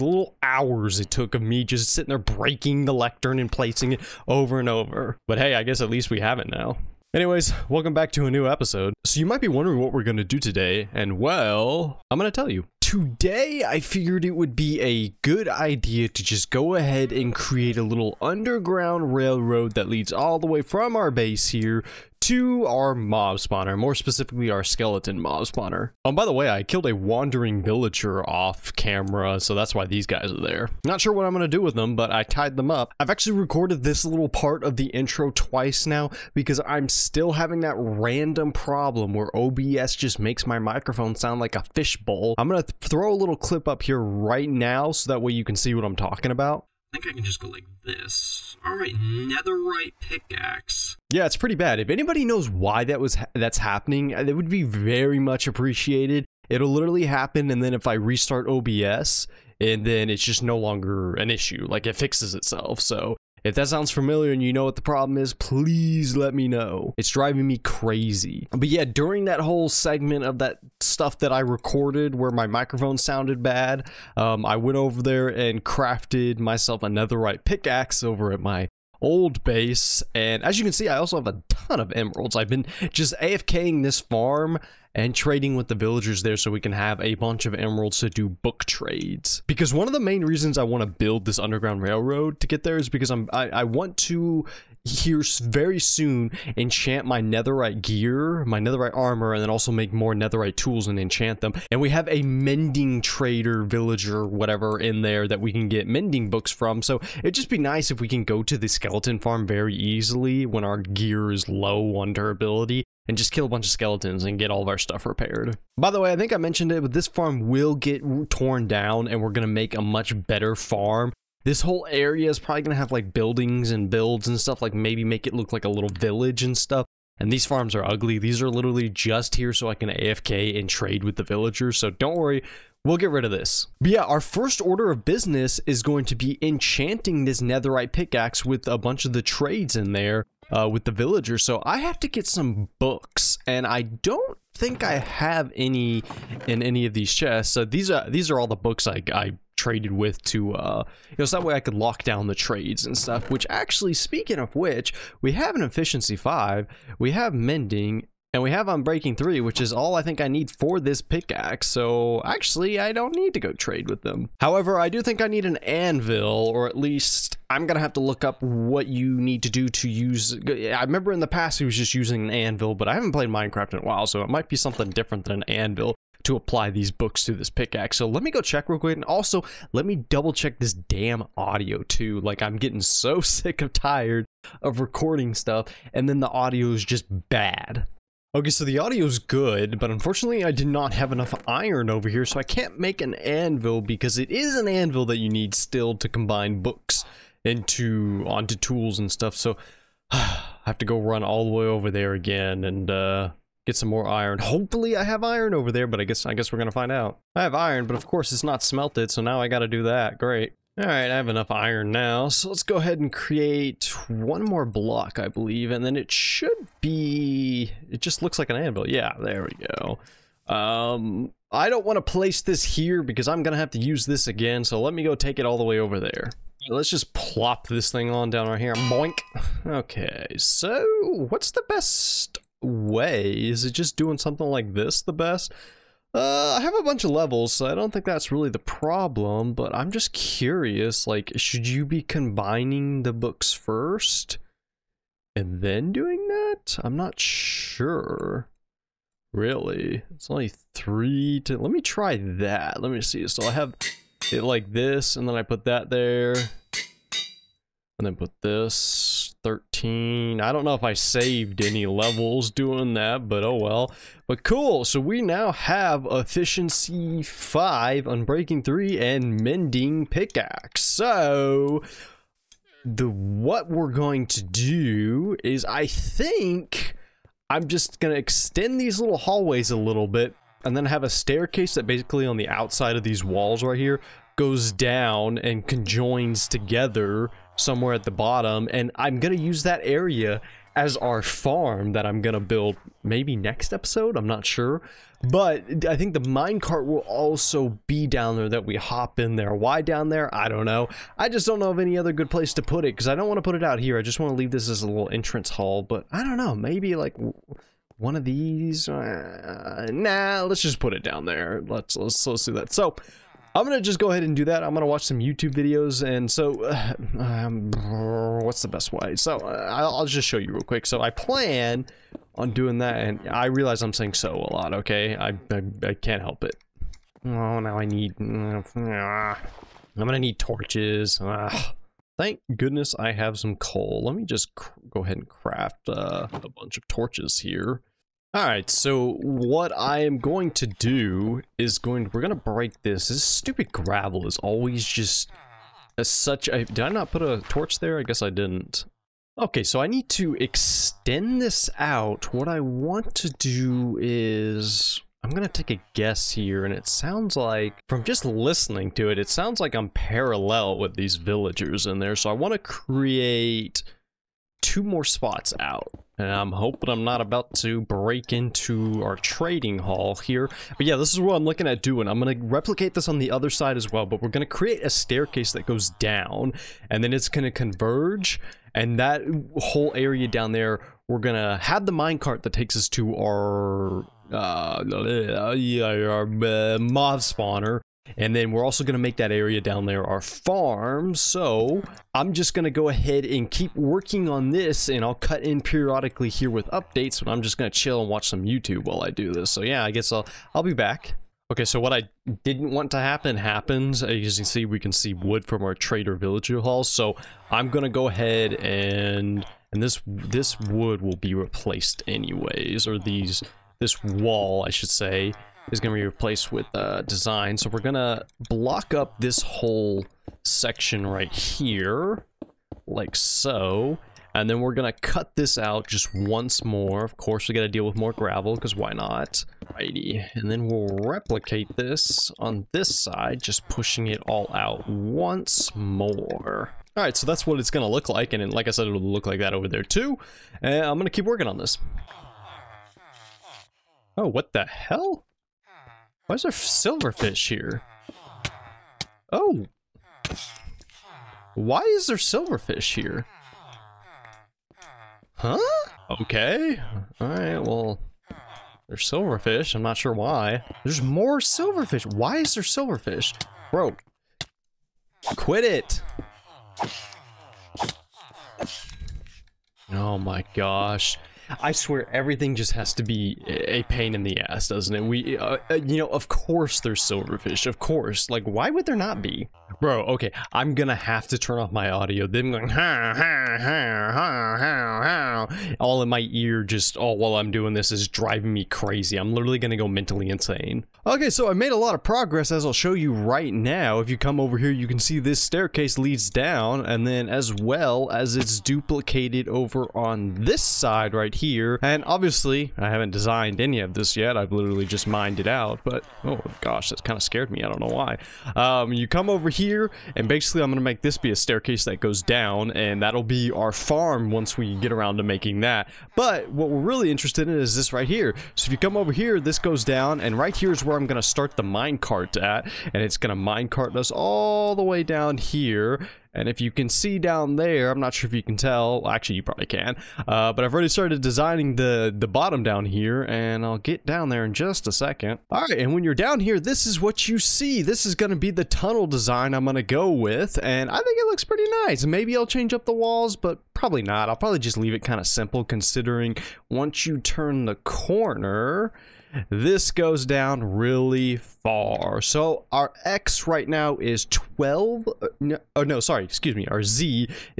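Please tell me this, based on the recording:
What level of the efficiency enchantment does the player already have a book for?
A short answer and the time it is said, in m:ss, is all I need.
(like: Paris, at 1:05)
5, at 2:35.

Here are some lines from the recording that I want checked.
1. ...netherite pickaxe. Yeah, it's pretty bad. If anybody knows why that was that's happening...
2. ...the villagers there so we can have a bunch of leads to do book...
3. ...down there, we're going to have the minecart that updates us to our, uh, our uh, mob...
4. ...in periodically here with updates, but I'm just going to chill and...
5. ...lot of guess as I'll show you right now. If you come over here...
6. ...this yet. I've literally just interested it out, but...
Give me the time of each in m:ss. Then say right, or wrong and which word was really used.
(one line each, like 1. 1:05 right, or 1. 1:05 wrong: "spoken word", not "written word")
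1. 0:48 right
2. 1:25 wrong: "emeralds", not "leads"
3. 6:20 wrong: "takes", not "updates"
4. 6:35 right
5. 8:11 wrong: "progress", not "guess"
6. 8:23 wrong: "mined", not "interested".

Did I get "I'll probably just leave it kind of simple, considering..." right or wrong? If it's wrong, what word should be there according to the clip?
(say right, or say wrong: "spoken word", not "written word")
right.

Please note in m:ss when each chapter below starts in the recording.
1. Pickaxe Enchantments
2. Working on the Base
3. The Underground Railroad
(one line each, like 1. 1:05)
1. 2:13
2. 4:33
3. 8:39.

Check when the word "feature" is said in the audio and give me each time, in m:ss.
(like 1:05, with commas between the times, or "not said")
not said.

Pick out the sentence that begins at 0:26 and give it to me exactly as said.
Oh, by the way, I killed a wandering villager off camera, so that's why these guys are there.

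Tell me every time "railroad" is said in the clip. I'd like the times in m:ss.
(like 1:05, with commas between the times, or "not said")
0:19, 1:31.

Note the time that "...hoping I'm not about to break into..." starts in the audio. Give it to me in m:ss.
6:06.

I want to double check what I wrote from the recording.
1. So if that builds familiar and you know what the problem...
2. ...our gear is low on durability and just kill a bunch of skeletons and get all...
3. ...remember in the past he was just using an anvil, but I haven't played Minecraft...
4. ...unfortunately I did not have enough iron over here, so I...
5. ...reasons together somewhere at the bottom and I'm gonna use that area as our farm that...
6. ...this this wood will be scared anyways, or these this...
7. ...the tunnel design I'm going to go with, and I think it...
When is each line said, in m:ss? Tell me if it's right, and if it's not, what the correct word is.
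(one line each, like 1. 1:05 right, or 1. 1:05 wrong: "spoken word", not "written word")
1. 1:02 wrong: "sounds", not "builds"
2. 1:50 right
3. 2:50 right
4. 3:09 right
5. 4:45 wrong: "conjoins", not "reasons"
6. 6:49 wrong: "replaced", not "scared"
7. 8:58 right.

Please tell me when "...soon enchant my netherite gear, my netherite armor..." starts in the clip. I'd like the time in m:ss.
1:35.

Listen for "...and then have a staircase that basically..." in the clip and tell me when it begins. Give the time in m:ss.
4:40.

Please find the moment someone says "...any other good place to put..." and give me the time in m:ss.
5:01.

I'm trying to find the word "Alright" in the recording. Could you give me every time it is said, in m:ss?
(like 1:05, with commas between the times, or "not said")
0:48, 3:30, 5:38, 7:37.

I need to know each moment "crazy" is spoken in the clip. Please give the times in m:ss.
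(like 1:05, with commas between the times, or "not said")
1:07, 8:08.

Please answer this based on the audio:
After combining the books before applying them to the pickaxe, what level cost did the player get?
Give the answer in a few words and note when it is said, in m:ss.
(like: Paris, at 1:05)
13, at 4:19.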